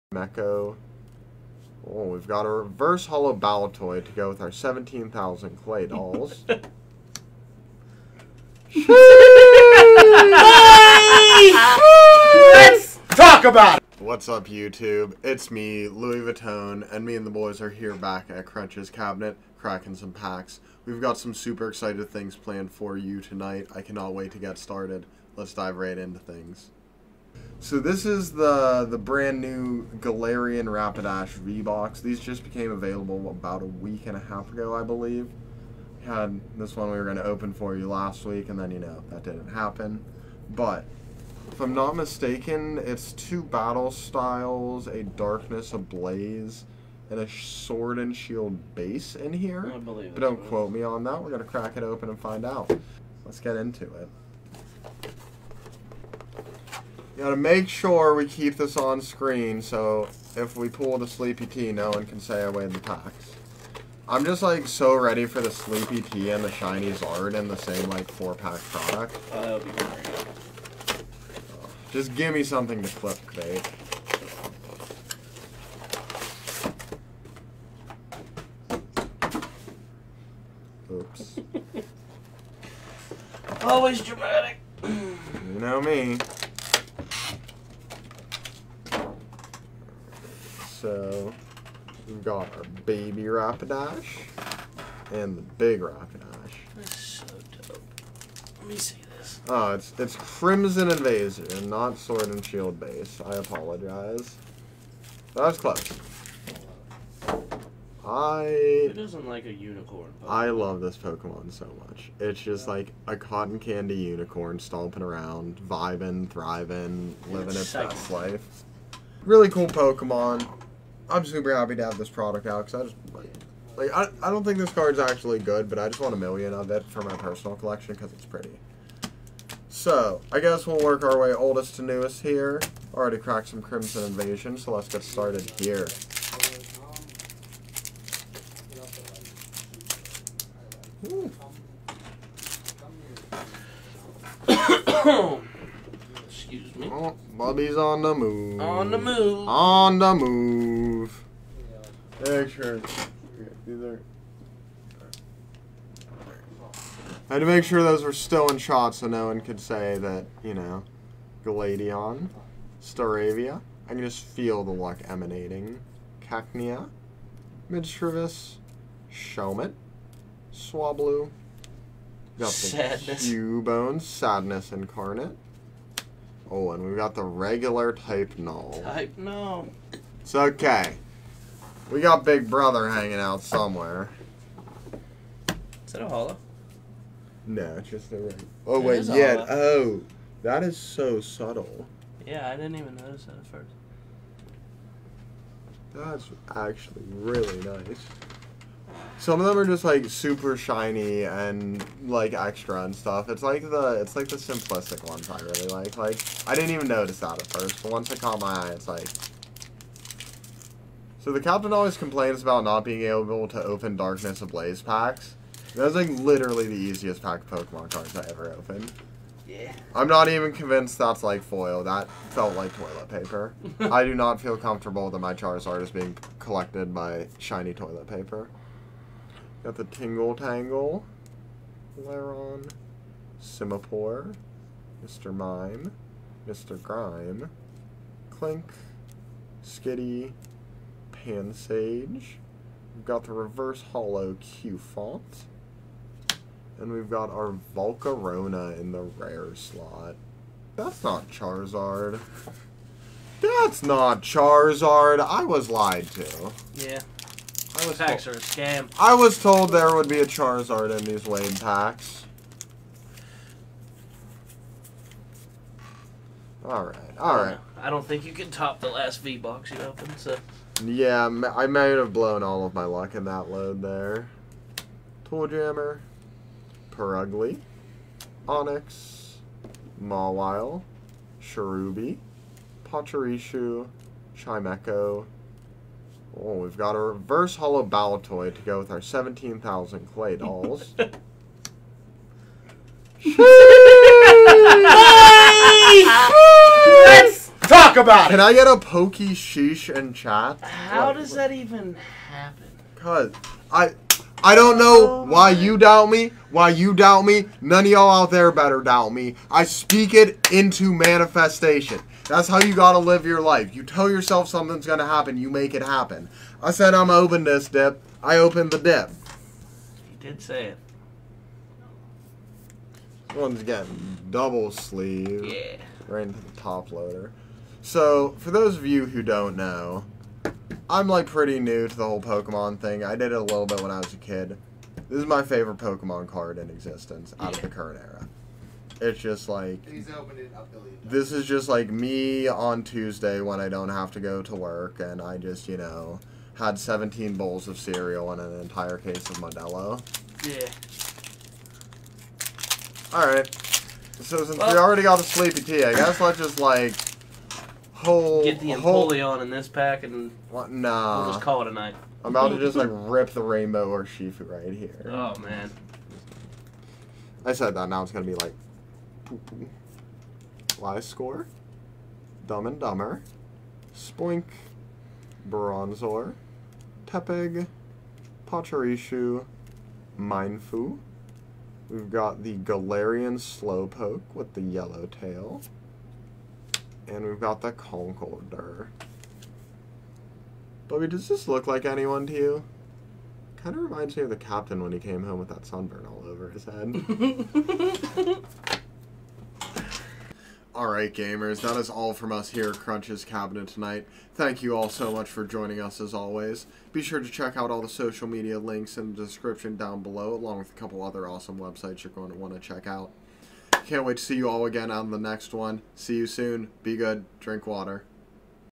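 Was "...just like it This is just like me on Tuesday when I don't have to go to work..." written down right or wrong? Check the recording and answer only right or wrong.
right.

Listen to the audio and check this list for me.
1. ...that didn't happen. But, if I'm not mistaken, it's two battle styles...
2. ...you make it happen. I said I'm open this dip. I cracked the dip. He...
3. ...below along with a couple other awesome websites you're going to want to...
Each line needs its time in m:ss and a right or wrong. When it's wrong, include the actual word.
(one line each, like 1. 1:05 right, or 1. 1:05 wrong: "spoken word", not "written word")
1. 0:39 right
2. 5:15 wrong: "opened", not "cracked"
3. 6:50 right.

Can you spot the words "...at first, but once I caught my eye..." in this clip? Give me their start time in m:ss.
3:27.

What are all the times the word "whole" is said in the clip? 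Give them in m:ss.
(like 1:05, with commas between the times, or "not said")
5:32, 5:58.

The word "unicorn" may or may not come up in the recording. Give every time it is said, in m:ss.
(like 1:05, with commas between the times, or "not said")
1:49, 1:53.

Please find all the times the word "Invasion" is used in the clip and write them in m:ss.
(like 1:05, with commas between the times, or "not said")
1:40, 2:14.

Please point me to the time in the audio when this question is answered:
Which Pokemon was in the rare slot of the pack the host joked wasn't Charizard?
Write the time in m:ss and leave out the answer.
4:07.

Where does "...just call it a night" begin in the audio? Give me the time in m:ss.
6:01.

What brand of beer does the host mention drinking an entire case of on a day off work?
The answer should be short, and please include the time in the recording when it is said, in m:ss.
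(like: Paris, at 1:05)
Modelo, at 5:49.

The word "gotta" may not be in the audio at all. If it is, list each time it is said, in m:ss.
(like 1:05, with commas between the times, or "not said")
0:57, 5:12.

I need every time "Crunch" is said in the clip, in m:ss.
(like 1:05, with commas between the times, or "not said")
0:18, 6:42.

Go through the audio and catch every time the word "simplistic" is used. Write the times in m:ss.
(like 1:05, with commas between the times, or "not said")
3:24.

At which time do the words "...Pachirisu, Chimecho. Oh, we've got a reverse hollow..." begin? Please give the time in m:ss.
4:42.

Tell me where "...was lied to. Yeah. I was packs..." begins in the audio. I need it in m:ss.
4:15.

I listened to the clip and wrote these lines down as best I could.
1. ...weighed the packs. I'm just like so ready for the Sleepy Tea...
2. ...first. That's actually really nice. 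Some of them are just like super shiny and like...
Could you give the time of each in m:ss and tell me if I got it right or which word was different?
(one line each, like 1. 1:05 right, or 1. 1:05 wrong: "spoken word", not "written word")
1. 1:02 right
2. 3:13 right.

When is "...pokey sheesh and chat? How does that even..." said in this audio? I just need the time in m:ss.
4:58.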